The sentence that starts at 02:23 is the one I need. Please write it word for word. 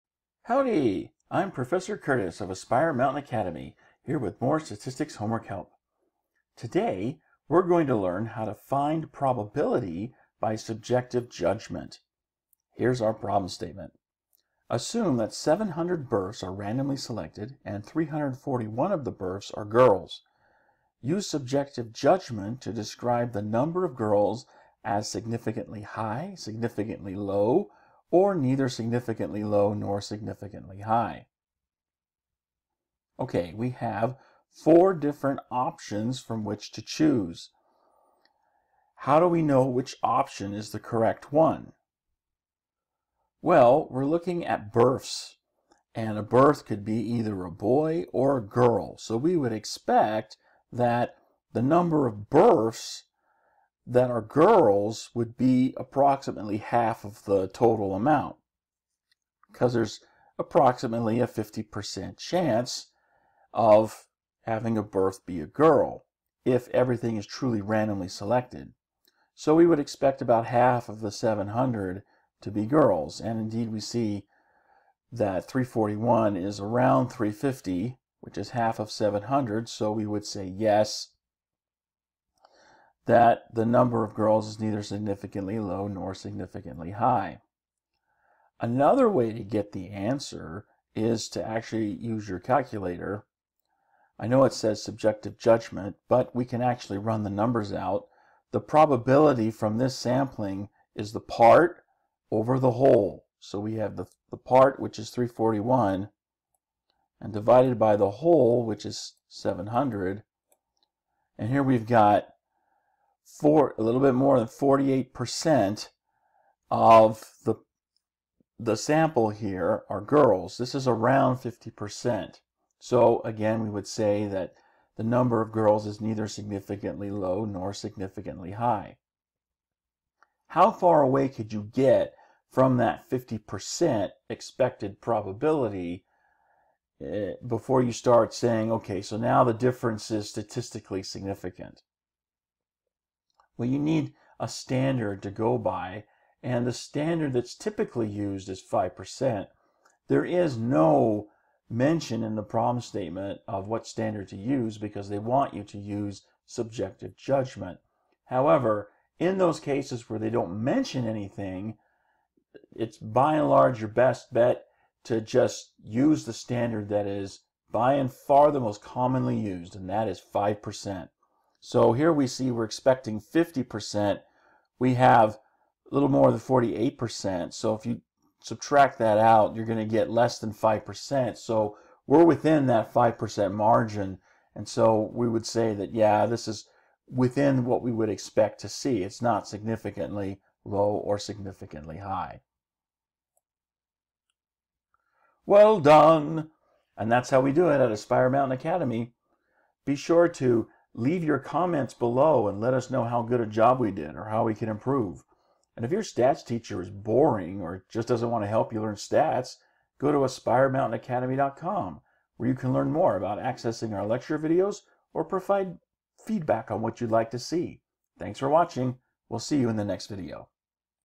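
Well, you need a standard to go by, and the standard that's typically used is 5%.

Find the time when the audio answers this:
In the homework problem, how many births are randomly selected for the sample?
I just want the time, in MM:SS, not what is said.
00:15.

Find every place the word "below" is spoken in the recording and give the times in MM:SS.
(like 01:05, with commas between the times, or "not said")
03:21.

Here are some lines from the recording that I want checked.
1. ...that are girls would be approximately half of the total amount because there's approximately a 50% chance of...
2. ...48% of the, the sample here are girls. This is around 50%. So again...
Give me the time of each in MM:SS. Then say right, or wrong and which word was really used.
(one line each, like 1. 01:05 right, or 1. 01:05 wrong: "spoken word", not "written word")
1. 00:53 right
2. 01:54 right.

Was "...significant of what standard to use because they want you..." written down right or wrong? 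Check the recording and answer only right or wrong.
wrong.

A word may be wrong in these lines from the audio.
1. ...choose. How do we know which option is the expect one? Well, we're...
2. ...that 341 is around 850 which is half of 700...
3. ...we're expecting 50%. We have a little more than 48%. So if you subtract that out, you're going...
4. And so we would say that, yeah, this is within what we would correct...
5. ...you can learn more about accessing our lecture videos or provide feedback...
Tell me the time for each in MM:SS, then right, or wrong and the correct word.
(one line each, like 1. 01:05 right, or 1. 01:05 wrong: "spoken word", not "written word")
1. 00:36 wrong: "correct", not "expect"
2. 01:15 wrong: "350", not "850"
3. 02:52 right
4. 03:04 wrong: "expect", not "correct"
5. 03:32 right.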